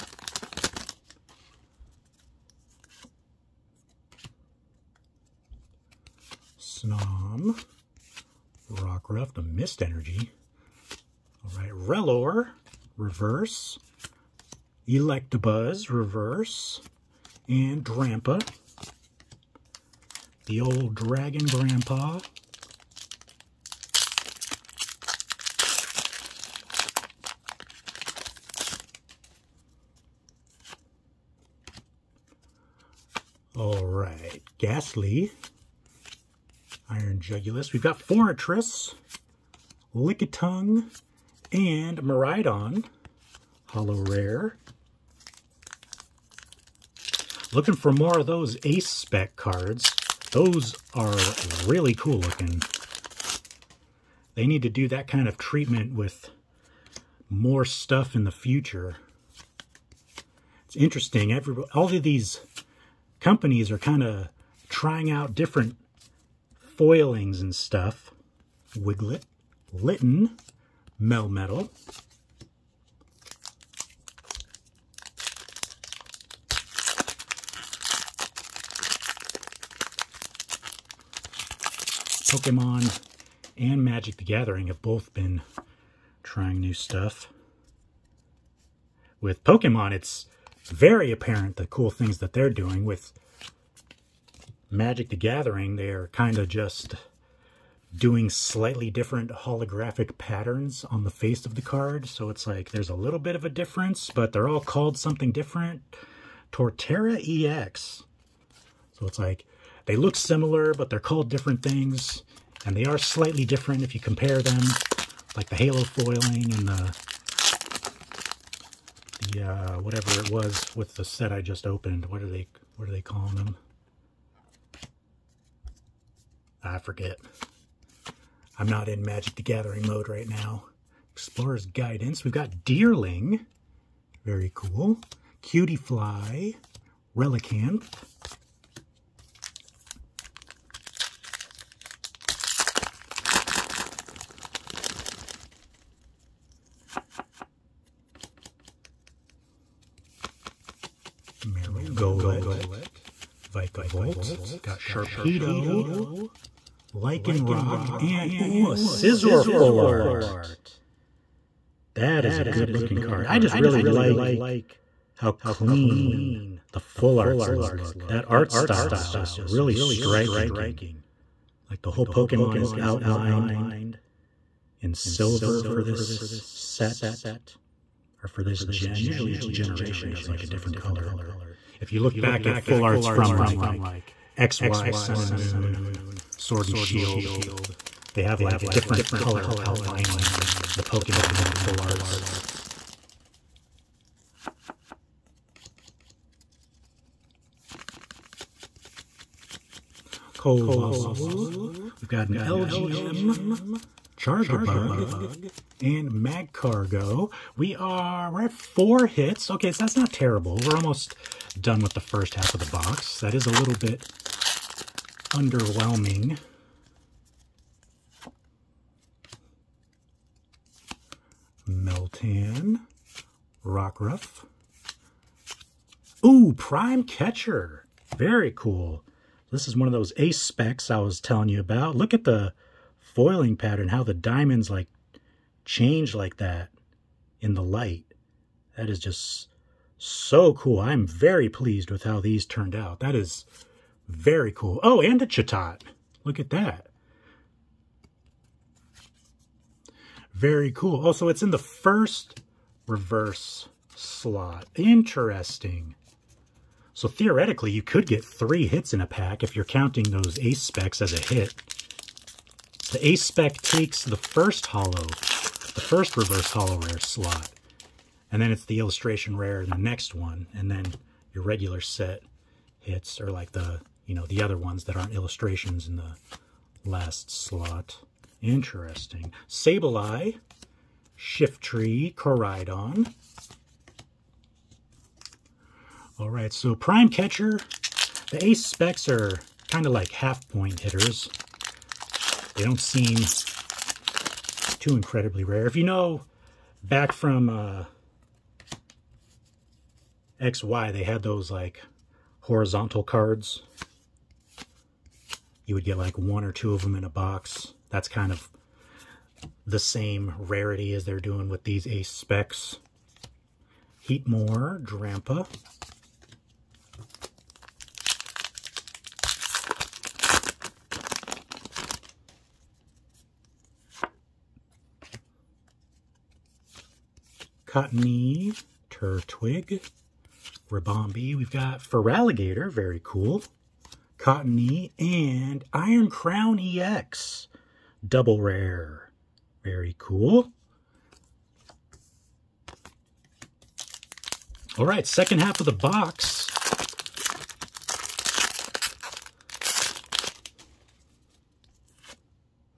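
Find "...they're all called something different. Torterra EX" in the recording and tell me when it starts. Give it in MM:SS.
01:44.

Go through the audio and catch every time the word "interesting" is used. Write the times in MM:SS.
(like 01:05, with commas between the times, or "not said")
01:00, 04:14, 04:38.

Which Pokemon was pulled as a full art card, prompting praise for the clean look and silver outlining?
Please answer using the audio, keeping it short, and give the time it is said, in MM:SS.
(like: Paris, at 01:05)
Scizor, at 02:38.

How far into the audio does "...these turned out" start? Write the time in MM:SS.
04:02.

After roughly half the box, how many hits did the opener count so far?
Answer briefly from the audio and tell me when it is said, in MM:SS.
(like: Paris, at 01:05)
4, at 03:28.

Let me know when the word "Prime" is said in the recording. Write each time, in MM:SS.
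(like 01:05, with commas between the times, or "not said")
03:46, 04:46.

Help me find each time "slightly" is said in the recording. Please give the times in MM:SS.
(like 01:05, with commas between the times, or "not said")
01:38, 01:52.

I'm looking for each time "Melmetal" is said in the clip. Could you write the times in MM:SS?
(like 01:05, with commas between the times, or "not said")
01:11.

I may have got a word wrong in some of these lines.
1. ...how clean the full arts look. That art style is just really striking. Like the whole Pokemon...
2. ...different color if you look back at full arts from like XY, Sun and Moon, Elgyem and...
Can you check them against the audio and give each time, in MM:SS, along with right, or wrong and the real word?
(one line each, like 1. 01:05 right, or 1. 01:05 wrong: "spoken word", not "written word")
1. 02:45 right
2. 03:00 wrong: "Sword", not "Elgyem".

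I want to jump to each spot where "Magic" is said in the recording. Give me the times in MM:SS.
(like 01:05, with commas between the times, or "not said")
01:23, 01:34, 02:09.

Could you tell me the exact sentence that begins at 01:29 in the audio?
With Pokemon, it's very apparent the cool things that they're doing.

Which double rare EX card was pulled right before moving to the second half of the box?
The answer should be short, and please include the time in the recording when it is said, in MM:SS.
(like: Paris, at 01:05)
Iron Crown EX, at 05:35.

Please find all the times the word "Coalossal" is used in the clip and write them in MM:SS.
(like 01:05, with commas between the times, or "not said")
03:20.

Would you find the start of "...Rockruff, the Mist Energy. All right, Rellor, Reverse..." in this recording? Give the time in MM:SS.
00:08.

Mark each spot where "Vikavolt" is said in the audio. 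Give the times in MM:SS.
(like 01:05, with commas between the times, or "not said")
02:33.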